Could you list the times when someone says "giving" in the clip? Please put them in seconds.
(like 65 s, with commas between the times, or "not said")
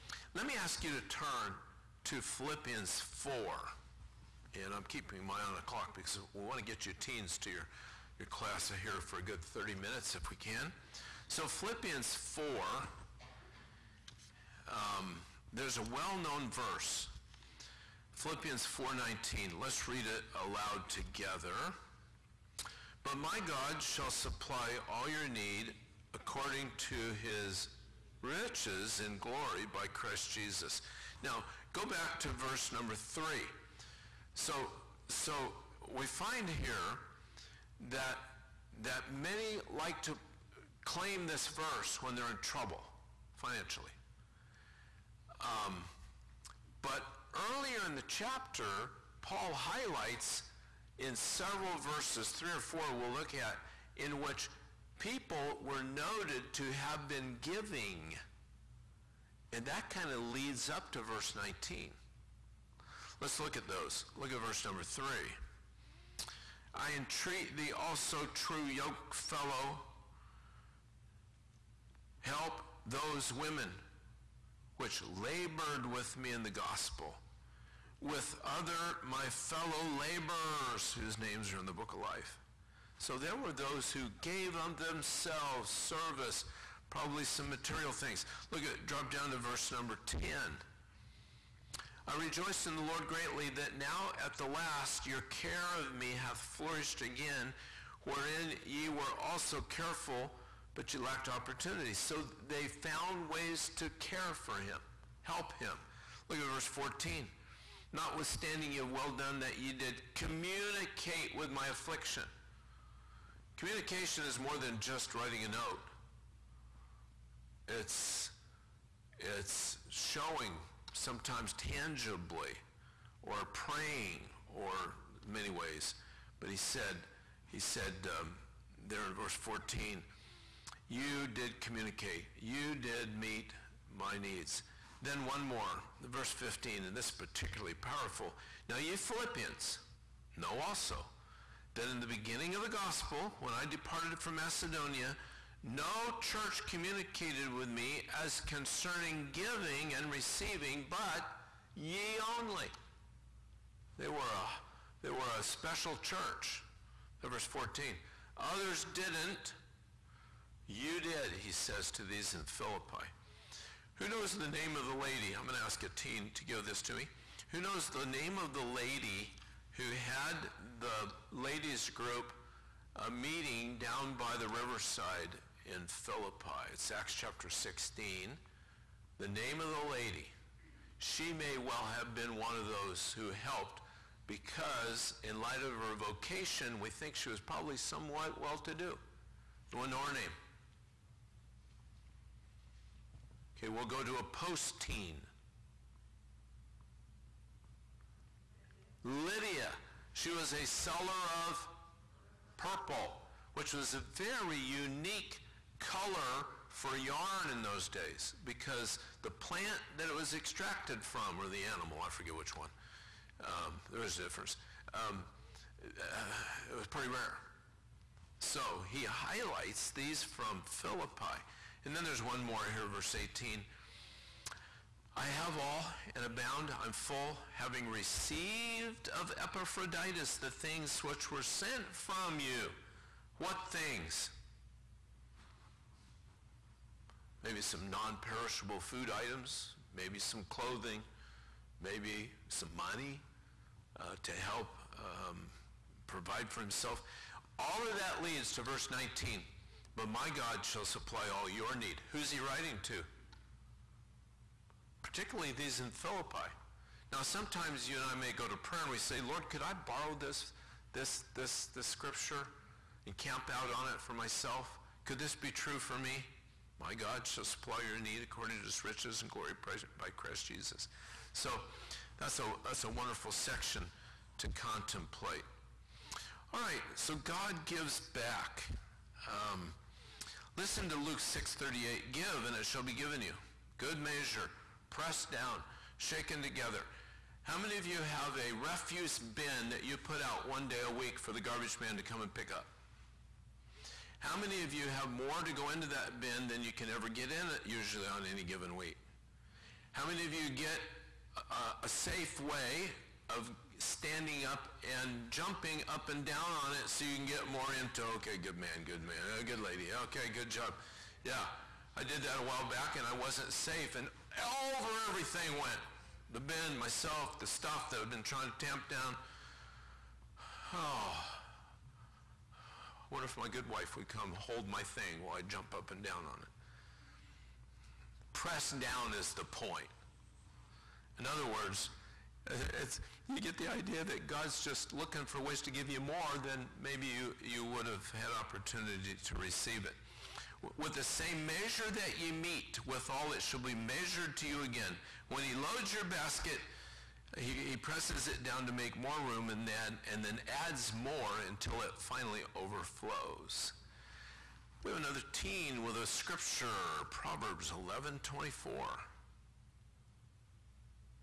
57 s, 149 s.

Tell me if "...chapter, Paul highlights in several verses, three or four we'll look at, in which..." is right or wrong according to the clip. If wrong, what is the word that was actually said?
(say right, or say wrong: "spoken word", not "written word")
right.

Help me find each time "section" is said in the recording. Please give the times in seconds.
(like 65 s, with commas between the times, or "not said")
273 s.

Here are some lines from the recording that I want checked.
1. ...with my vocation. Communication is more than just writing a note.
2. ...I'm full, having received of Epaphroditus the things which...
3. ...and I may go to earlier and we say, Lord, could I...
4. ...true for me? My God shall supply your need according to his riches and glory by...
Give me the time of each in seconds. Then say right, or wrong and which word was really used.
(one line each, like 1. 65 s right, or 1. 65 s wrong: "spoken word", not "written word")
1. 111 s wrong: "affliction", not "vocation"
2. 226 s right
3. 257 s wrong: "prayer", not "earlier"
4. 265 s right.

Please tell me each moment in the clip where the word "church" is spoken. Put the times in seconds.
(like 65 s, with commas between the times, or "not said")
146 s, 156 s.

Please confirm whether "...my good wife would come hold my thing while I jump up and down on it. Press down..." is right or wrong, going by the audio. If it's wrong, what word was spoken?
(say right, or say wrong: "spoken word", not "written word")
right.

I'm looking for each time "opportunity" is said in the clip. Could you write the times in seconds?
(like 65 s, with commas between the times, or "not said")
101 s, 338 s.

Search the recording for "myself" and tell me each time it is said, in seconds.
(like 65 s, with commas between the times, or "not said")
264 s, 316 s.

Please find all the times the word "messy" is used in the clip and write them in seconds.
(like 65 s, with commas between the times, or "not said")
not said.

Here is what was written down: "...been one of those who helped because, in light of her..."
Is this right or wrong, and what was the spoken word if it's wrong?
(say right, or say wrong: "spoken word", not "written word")
right.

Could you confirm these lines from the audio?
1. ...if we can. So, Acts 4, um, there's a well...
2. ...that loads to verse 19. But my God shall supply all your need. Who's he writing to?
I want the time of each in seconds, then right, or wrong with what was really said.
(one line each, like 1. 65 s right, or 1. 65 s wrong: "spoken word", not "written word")
1. 10 s wrong: "Philippians", not "Acts"
2. 247 s wrong: "leads", not "loads".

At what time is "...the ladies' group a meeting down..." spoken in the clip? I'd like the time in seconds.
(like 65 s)
170 s.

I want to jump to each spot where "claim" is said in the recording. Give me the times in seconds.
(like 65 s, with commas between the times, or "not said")
40 s.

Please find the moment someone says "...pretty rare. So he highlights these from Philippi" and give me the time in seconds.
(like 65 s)
216 s.